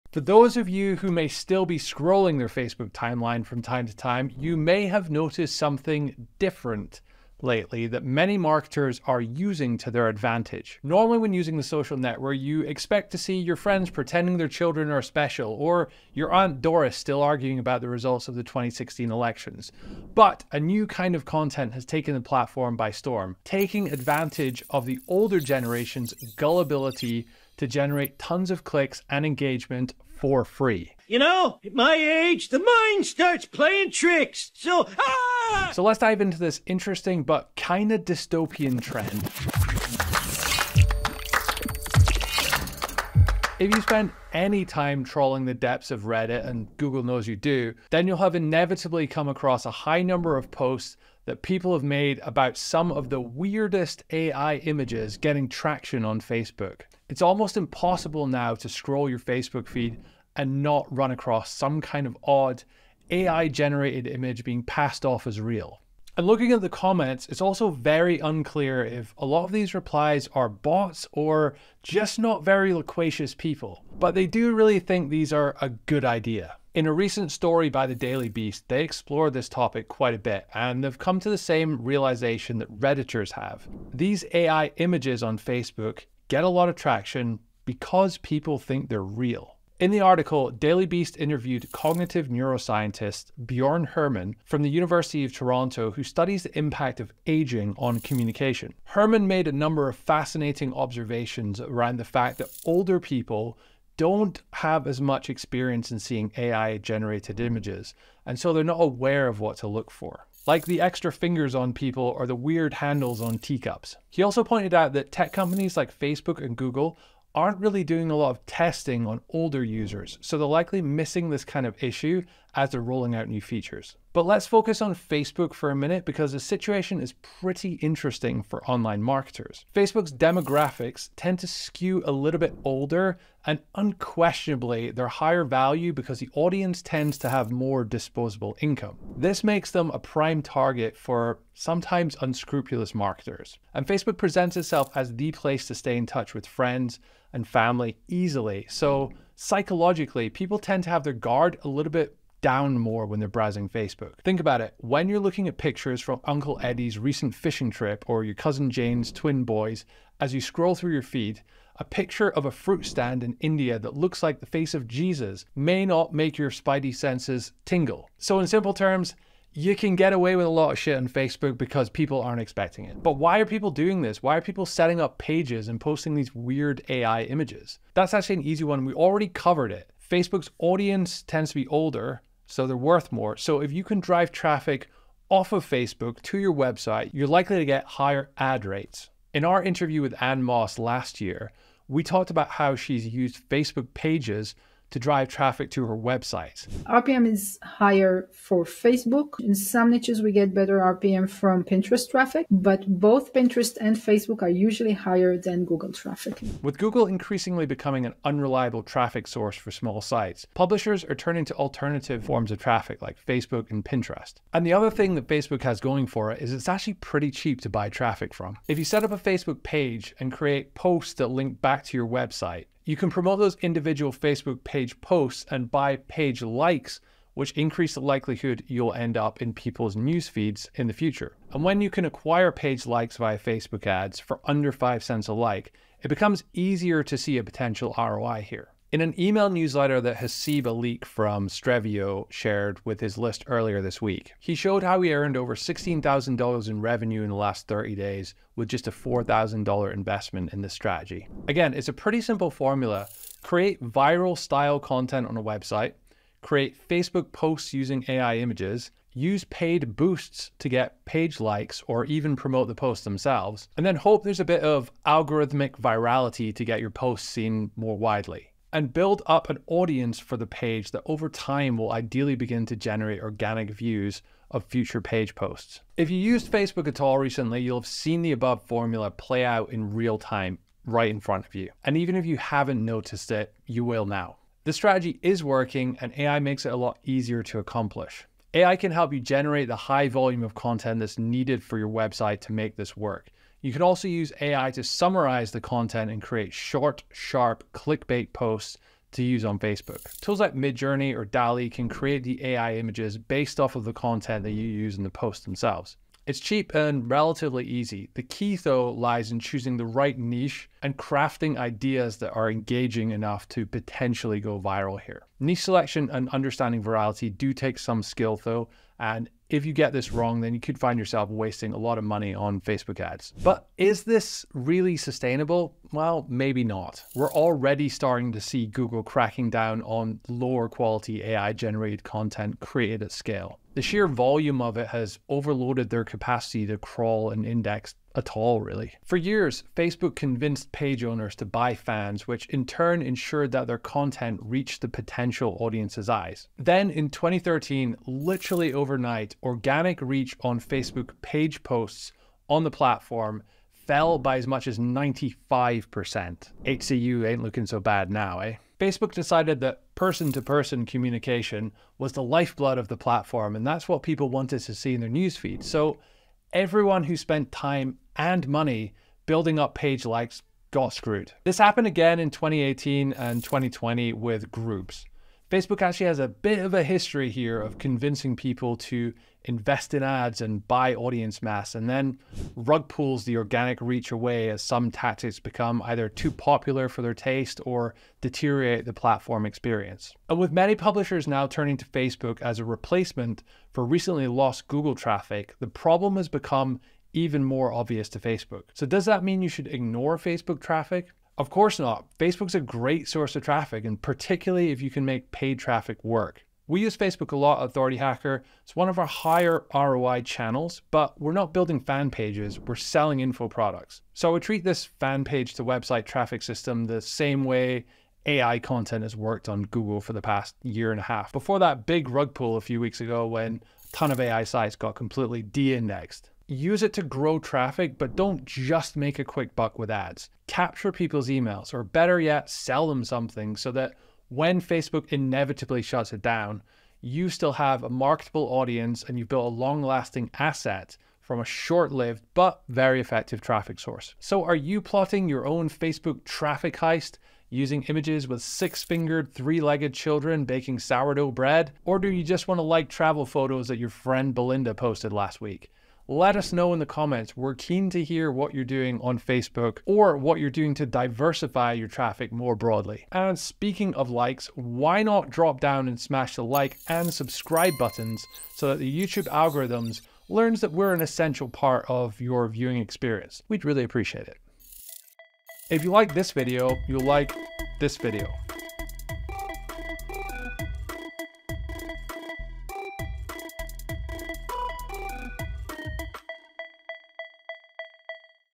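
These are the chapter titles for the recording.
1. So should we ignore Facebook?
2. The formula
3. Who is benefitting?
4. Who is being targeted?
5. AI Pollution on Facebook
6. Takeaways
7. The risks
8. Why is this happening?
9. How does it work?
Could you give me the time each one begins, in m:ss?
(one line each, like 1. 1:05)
1. 6:41
2. 4:09
3. 3:09
4. 2:11
5. 0:44
6. 7:08
7. 4:35
8. 1:24
9. 3:38.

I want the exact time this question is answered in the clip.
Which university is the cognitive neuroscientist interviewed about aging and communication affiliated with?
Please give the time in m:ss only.
1:34.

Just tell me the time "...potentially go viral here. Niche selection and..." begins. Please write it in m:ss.
5:13.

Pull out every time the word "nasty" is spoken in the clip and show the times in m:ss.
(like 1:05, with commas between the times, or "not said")
not said.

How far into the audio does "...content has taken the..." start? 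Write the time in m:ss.
0:21.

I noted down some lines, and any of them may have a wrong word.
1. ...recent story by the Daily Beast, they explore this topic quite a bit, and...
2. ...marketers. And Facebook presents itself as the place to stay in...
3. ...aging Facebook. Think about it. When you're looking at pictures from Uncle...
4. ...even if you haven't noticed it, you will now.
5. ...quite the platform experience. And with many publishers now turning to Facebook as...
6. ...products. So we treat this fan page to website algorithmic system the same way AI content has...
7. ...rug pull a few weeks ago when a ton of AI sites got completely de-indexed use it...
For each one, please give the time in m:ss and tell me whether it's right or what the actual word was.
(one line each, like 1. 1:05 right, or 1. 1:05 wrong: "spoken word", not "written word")
1. 1:16 right
2. 2:22 right
3. 2:33 wrong: "browsing", not "aging"
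4. 4:41 right
5. 6:28 wrong: "deteriorate", not "quite"
6. 6:53 wrong: "traffic", not "algorithmic"
7. 7:02 right.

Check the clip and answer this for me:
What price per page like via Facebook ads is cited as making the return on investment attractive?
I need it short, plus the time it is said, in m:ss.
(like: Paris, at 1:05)
under 5 cents, at 3:54.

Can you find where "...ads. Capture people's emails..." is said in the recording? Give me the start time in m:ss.
7:09.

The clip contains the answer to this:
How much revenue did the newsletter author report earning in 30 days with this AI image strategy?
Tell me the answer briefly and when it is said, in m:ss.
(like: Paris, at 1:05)
over $16,000, at 4:05.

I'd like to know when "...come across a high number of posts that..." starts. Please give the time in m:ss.
0:49.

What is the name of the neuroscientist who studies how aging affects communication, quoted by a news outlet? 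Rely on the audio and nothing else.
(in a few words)
Bjorn Herrmann.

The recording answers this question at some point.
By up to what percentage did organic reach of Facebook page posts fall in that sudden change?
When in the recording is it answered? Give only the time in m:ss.
5:54.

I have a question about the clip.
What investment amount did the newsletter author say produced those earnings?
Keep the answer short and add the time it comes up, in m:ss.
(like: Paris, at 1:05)
$4,000, at 4:08.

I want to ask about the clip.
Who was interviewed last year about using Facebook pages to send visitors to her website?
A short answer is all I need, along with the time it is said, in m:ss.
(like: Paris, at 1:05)
Anne Moss, at 3:10.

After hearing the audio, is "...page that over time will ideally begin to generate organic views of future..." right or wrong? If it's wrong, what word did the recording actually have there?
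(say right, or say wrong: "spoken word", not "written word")
right.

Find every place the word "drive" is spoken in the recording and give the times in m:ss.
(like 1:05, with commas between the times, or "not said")
3:04, 3:14.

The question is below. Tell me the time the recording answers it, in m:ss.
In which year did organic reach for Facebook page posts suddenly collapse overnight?
5:47.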